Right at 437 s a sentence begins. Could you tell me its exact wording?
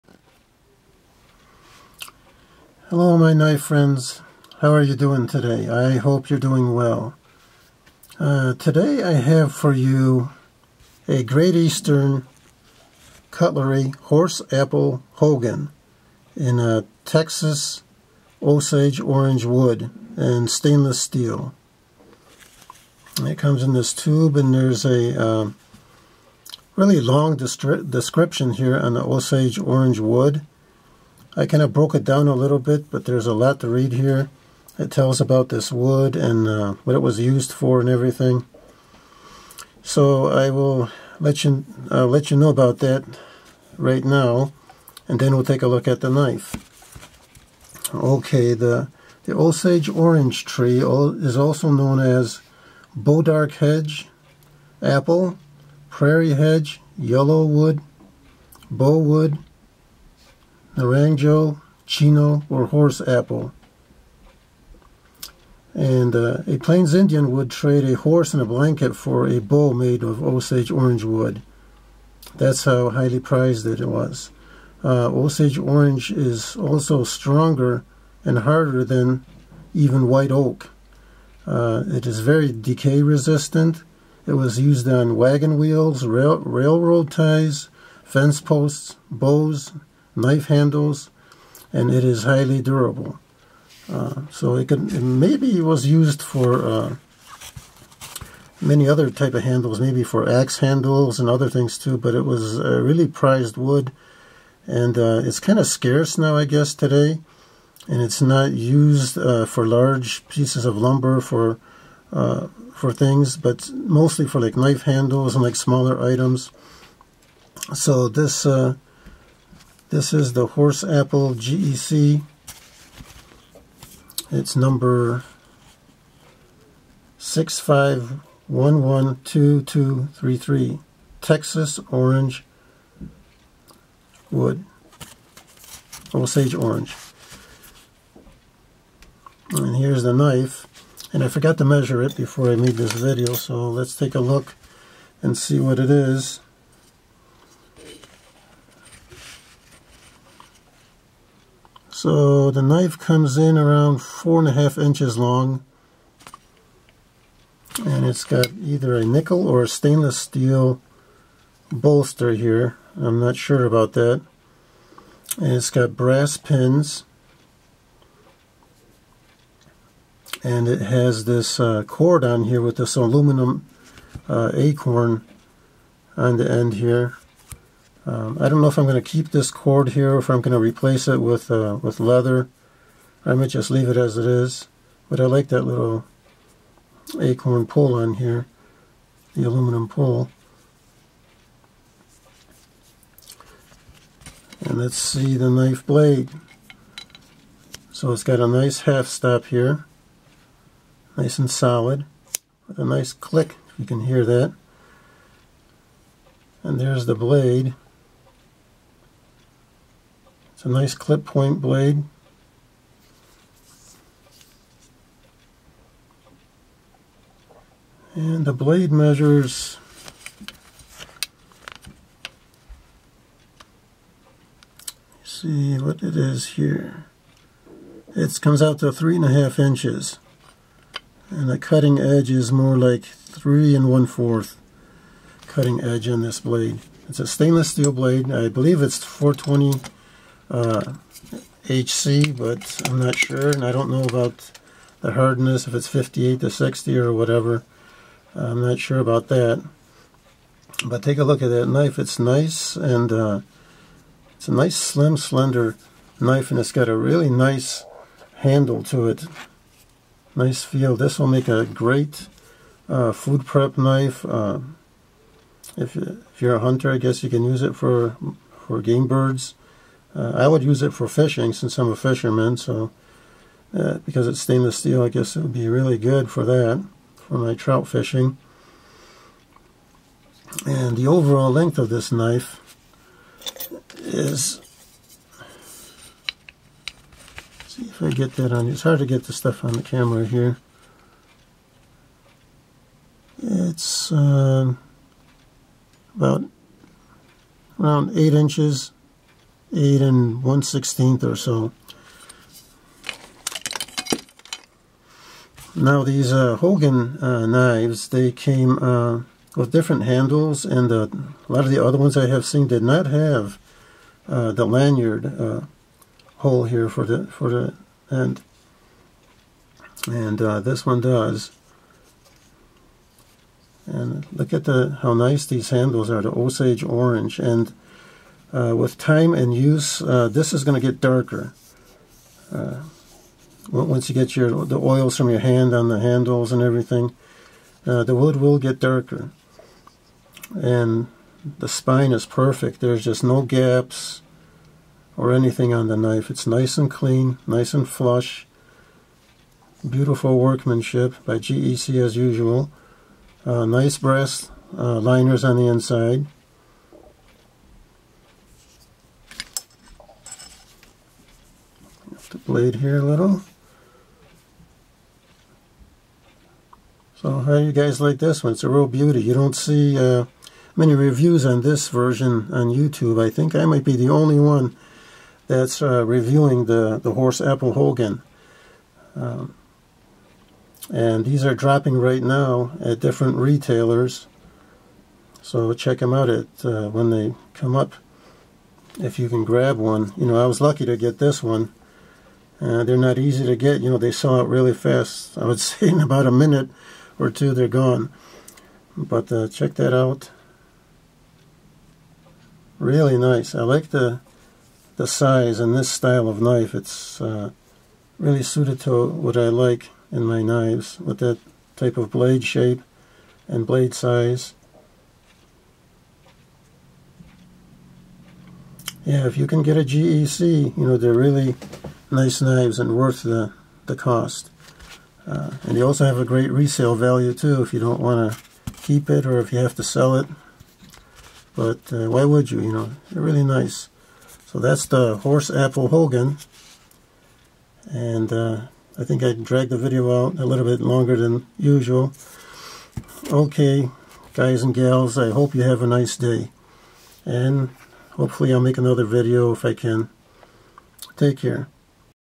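And uh, I think I dragged the video out a little bit longer than usual.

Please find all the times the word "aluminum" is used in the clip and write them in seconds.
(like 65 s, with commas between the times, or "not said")
172 s, 189 s.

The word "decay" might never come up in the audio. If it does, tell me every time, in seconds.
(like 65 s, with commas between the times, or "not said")
82 s.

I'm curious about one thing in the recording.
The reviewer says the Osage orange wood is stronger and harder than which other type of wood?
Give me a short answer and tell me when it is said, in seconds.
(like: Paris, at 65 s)
White oak, at 80 s.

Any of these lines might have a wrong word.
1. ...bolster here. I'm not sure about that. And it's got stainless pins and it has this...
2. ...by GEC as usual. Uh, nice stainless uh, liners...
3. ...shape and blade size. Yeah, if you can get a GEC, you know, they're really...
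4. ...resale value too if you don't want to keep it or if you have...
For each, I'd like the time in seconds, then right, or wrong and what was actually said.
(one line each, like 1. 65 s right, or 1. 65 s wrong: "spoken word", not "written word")
1. 161 s wrong: "brass", not "stainless"
2. 351 s wrong: "brass", not "stainless"
3. 412 s right
4. 426 s right.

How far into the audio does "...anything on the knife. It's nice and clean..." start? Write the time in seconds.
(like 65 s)
345 s.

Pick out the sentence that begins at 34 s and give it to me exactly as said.
It tells about this wood and uh, what it was used for and everything.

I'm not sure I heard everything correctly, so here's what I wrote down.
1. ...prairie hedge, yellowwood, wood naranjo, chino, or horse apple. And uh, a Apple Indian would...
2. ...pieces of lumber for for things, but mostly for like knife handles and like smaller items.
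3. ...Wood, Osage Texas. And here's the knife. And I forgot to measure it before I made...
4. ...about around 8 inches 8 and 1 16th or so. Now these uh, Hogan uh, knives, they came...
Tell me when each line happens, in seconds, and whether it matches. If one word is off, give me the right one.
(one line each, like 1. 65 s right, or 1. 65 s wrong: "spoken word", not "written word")
1. 55 s wrong: "Plains", not "Apple"
2. 110 s right
3. 134 s wrong: "Orange", not "Texas"
4. 296 s right.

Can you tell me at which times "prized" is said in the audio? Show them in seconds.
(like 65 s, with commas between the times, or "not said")
73 s, 103 s.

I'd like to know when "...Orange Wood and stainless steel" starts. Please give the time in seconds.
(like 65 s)
18 s.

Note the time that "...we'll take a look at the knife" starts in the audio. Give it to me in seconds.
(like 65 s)
45 s.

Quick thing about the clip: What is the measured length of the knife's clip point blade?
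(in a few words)
3.5 inches.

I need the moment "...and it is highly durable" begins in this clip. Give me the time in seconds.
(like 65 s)
91 s.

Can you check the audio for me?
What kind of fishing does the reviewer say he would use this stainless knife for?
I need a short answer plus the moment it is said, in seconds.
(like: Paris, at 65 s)
Trout fishing, at 277 s.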